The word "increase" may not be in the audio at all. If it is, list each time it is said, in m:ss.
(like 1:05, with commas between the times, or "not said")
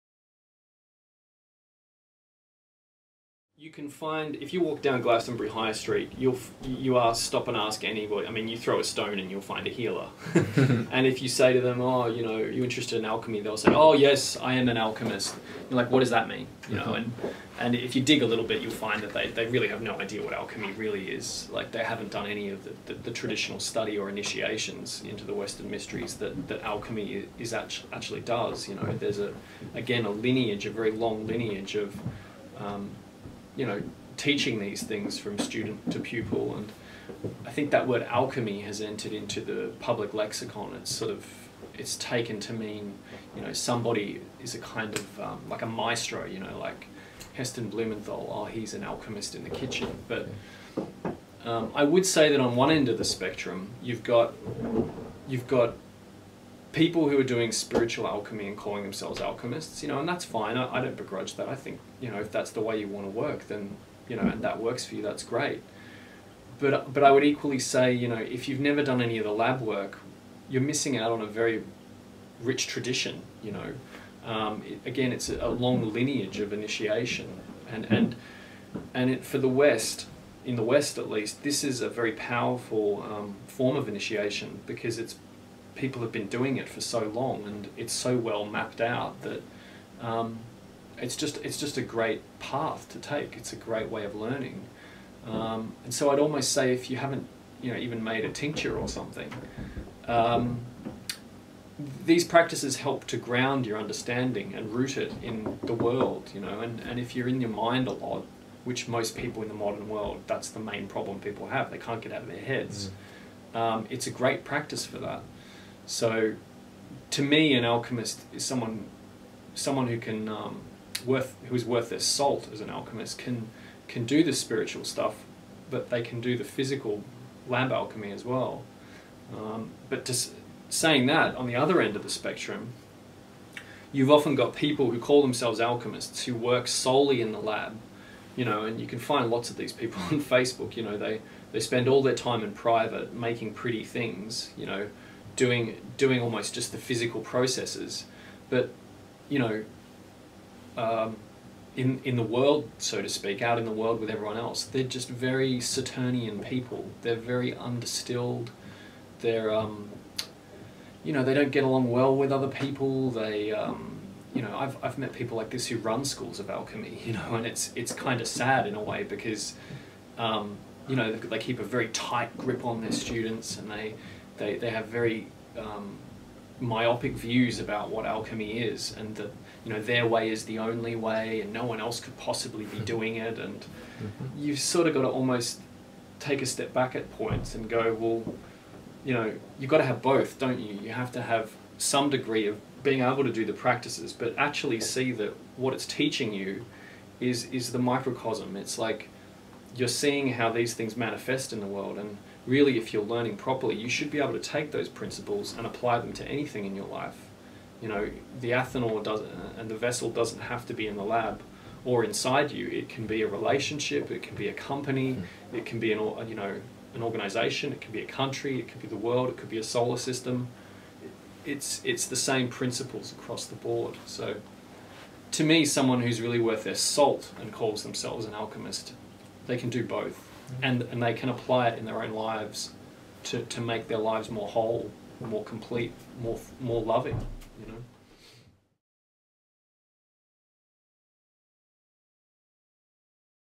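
not said.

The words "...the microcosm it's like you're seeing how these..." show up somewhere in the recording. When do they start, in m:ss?
3:17.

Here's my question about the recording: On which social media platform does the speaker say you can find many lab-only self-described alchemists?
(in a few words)
Facebook.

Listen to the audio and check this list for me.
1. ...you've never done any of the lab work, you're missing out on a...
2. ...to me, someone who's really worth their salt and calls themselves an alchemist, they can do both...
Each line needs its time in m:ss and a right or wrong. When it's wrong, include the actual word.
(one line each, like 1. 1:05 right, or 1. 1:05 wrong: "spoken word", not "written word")
1. 1:08 right
2. 3:45 right.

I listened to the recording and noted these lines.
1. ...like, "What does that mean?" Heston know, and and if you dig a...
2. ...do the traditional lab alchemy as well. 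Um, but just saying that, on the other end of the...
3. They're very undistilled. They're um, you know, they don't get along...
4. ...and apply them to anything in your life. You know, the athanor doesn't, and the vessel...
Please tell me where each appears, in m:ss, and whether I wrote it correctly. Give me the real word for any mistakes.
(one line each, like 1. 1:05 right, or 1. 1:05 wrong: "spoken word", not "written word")
1. 0:15 wrong: "You", not "Heston"
2. 2:06 wrong: "physical", not "traditional"
3. 2:37 right
4. 3:25 right.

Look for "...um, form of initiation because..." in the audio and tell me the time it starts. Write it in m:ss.
1:23.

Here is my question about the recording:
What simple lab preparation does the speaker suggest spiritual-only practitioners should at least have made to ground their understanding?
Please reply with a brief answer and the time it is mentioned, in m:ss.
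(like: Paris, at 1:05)
A tincture, at 1:38.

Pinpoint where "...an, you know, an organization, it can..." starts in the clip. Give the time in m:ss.
3:35.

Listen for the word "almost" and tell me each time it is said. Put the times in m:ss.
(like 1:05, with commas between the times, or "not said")
1:36, 2:26, 3:05.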